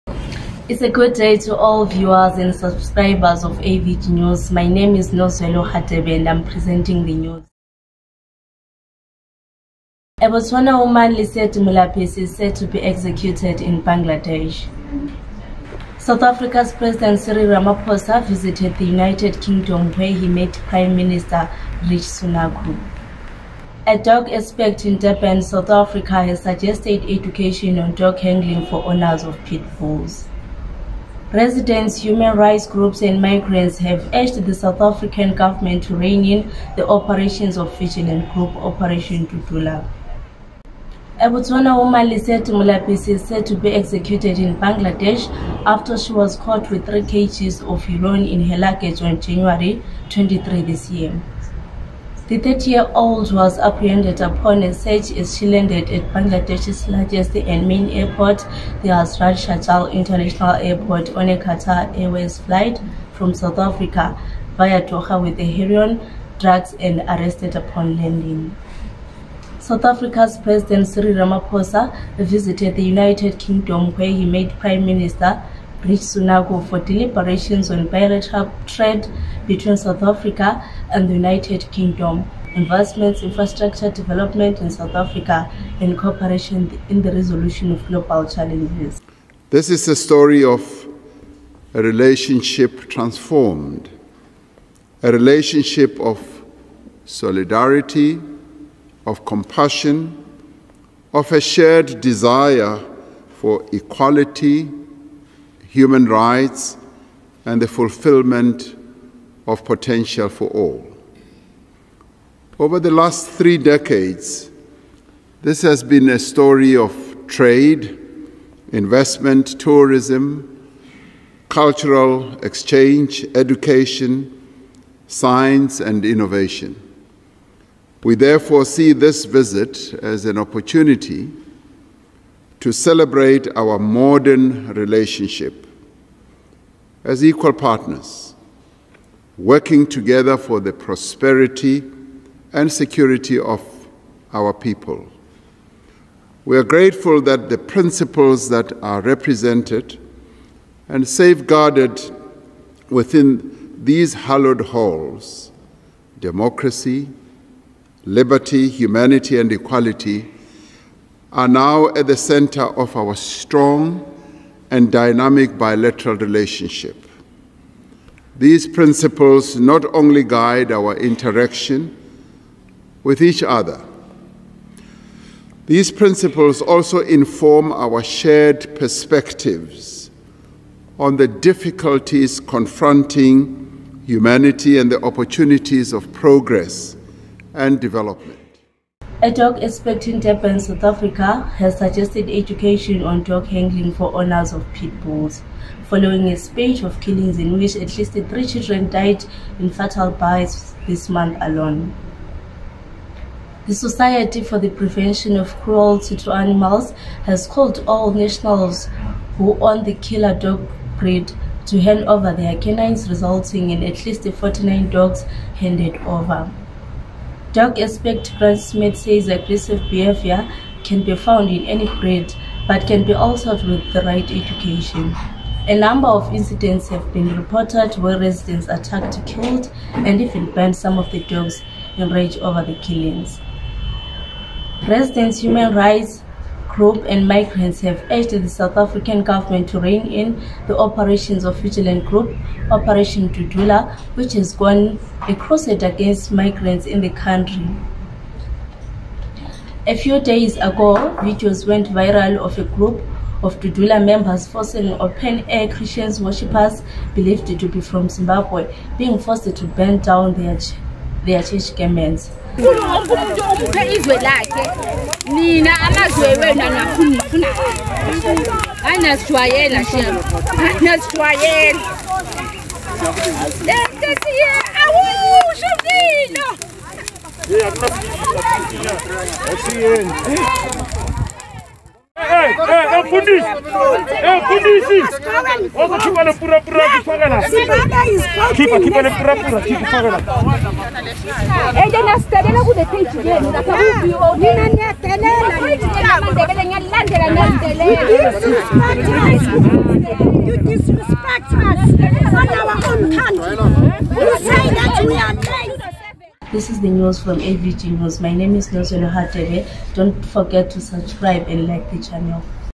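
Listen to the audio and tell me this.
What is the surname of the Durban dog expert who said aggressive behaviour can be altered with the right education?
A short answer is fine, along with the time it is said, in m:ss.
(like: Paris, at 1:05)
Smith, at 3:38.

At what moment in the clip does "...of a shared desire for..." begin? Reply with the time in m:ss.
1:41.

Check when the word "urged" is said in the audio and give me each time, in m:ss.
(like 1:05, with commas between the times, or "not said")
0:34, 3:58.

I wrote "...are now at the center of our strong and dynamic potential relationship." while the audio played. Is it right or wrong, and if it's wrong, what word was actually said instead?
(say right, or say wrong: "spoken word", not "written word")
wrong: "bilateral", not "potential".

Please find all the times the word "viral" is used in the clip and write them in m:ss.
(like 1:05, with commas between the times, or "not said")
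4:11.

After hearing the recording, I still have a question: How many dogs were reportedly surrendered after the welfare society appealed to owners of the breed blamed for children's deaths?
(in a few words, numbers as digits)
49.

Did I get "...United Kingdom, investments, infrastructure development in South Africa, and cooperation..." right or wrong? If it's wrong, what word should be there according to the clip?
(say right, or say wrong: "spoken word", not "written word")
right.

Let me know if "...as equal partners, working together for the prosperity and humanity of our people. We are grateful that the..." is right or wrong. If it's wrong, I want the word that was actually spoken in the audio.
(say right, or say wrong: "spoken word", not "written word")
wrong: "security", not "humanity".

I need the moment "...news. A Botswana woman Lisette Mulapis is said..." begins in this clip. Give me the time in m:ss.
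0:07.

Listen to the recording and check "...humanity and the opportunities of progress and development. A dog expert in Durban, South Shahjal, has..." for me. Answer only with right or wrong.
wrong.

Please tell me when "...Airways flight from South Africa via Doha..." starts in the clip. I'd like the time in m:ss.
1:01.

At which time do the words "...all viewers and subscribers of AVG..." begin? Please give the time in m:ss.
0:01.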